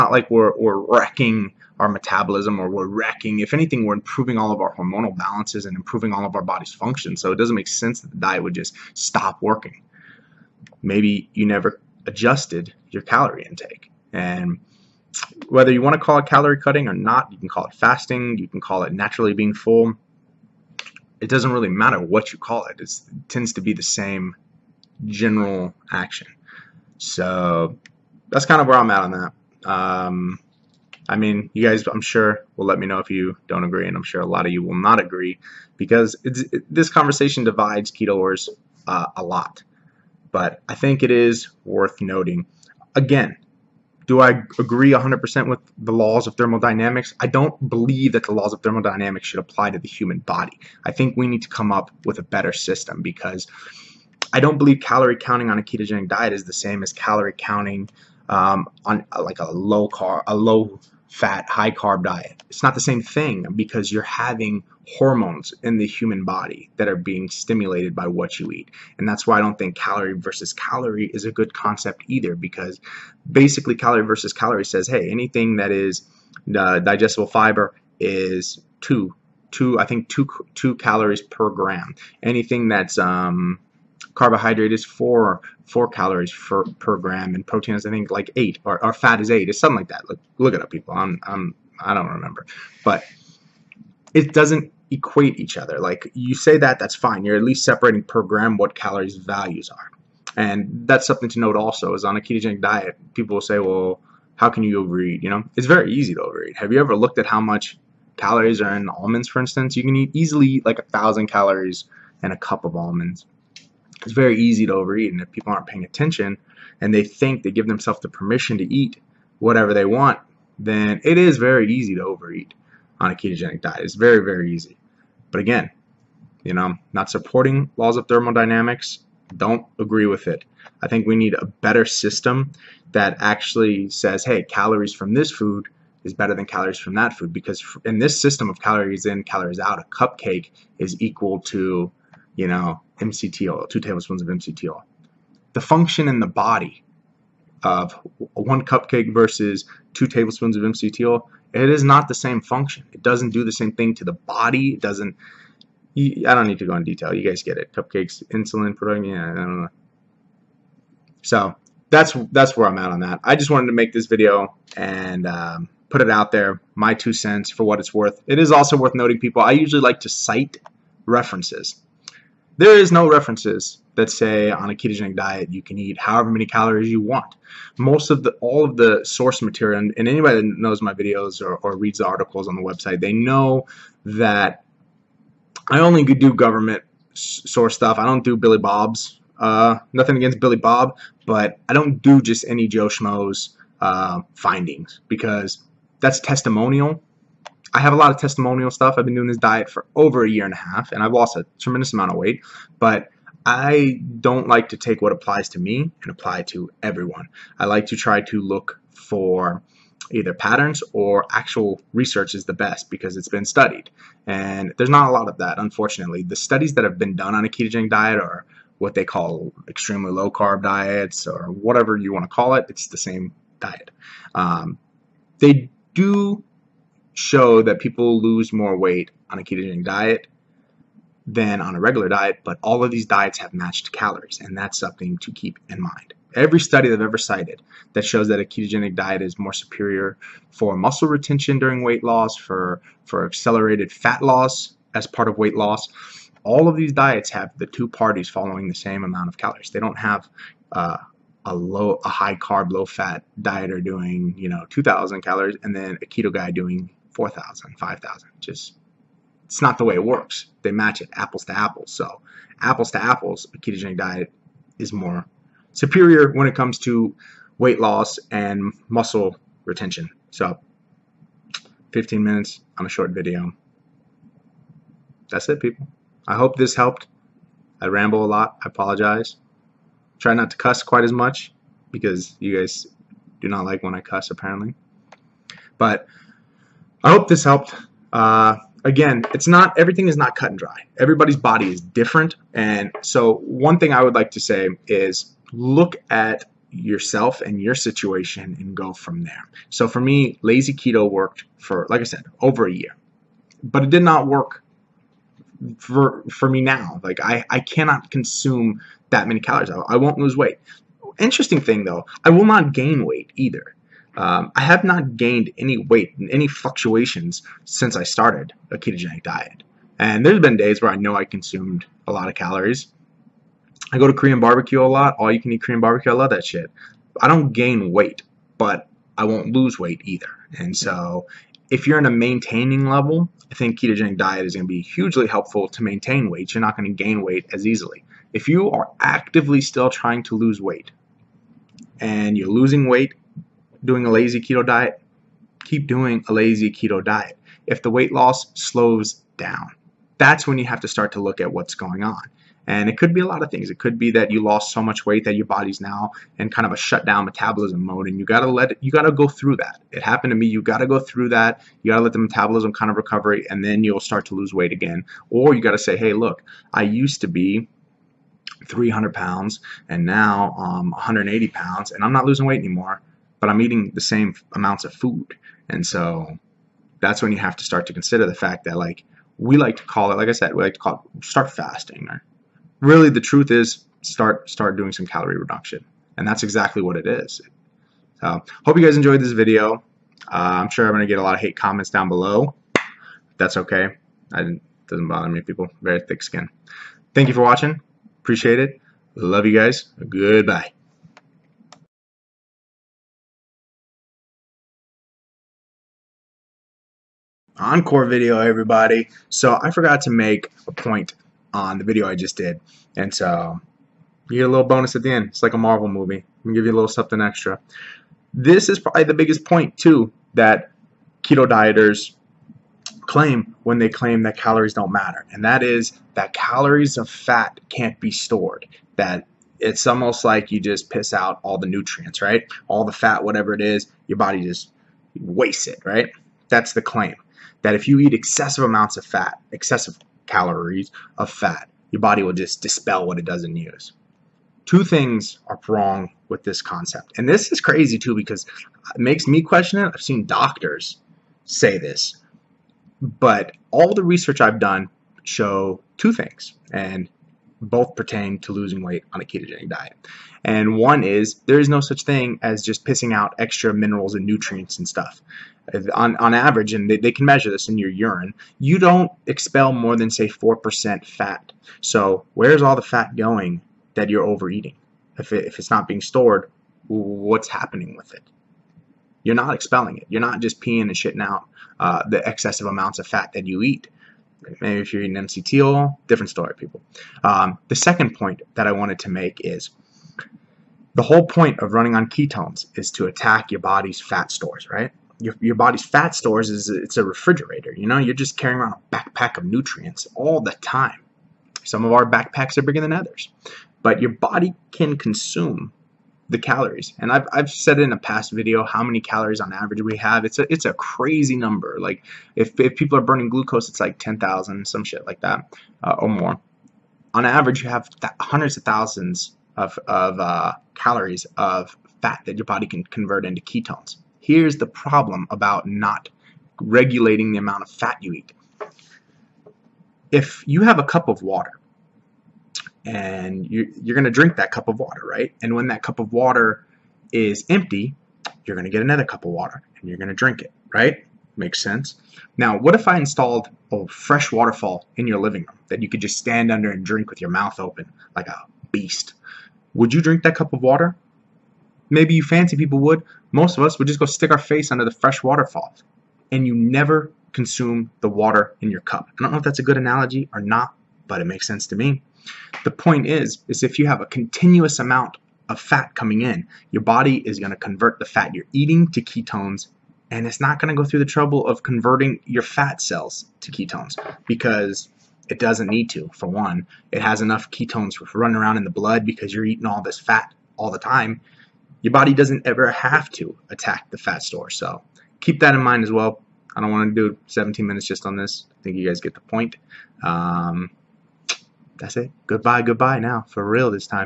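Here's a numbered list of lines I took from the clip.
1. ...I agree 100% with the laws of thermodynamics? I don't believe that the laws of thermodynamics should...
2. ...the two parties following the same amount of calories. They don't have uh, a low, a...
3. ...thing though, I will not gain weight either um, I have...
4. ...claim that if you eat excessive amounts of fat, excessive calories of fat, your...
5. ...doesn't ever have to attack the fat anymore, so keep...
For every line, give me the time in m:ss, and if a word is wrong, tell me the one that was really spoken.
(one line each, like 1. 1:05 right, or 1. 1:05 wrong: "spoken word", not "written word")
1. 0:44 right
2. 4:07 right
3. 5:11 right
4. 7:16 right
5. 9:42 wrong: "store", not "anymore".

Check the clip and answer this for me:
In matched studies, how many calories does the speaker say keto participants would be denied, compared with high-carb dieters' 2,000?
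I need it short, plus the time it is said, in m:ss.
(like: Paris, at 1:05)
4,000 to 5,000, at 4:17.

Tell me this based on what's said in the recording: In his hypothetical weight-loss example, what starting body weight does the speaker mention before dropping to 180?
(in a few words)
300 pounds.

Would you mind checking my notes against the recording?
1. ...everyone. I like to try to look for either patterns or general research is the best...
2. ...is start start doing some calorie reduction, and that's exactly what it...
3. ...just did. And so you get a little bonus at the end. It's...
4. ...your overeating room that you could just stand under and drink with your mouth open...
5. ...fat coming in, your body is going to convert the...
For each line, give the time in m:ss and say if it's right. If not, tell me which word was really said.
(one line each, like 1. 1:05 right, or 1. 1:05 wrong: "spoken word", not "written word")
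1. 3:26 wrong: "actual", not "general"
2. 6:23 right
3. 6:52 right
4. 9:05 wrong: "living", not "overeating"
5. 9:25 right.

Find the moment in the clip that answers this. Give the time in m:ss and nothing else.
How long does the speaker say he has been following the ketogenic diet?
3:19.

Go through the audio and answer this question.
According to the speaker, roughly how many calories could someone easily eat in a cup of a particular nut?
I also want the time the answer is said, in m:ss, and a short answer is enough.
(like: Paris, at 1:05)
1,000, at 1:50.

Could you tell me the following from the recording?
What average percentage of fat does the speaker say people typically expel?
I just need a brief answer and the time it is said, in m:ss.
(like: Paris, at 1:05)
4%, at 7:50.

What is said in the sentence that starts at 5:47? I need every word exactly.
If the weight loss slows down, that's when you have to start to look at what's going on.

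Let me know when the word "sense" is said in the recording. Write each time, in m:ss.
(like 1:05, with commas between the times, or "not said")
0:07, 9:01, 9:21.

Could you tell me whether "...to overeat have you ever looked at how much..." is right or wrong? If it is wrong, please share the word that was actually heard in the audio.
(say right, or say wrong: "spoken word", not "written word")
right.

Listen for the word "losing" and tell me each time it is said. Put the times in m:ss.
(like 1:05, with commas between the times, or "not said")
5:42, 6:12, 7:38.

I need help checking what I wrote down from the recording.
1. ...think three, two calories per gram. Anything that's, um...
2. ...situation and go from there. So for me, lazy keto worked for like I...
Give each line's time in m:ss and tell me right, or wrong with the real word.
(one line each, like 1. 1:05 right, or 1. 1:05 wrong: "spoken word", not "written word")
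1. 1:19 wrong: "two", not "three"
2. 4:57 right.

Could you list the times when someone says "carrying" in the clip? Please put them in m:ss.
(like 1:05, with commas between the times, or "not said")
8:18.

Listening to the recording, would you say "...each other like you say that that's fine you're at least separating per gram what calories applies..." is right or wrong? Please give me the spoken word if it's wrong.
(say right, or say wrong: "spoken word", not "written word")
wrong: "values", not "applies".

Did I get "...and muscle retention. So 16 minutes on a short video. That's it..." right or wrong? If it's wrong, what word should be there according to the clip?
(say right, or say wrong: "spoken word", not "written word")
wrong: "15", not "16".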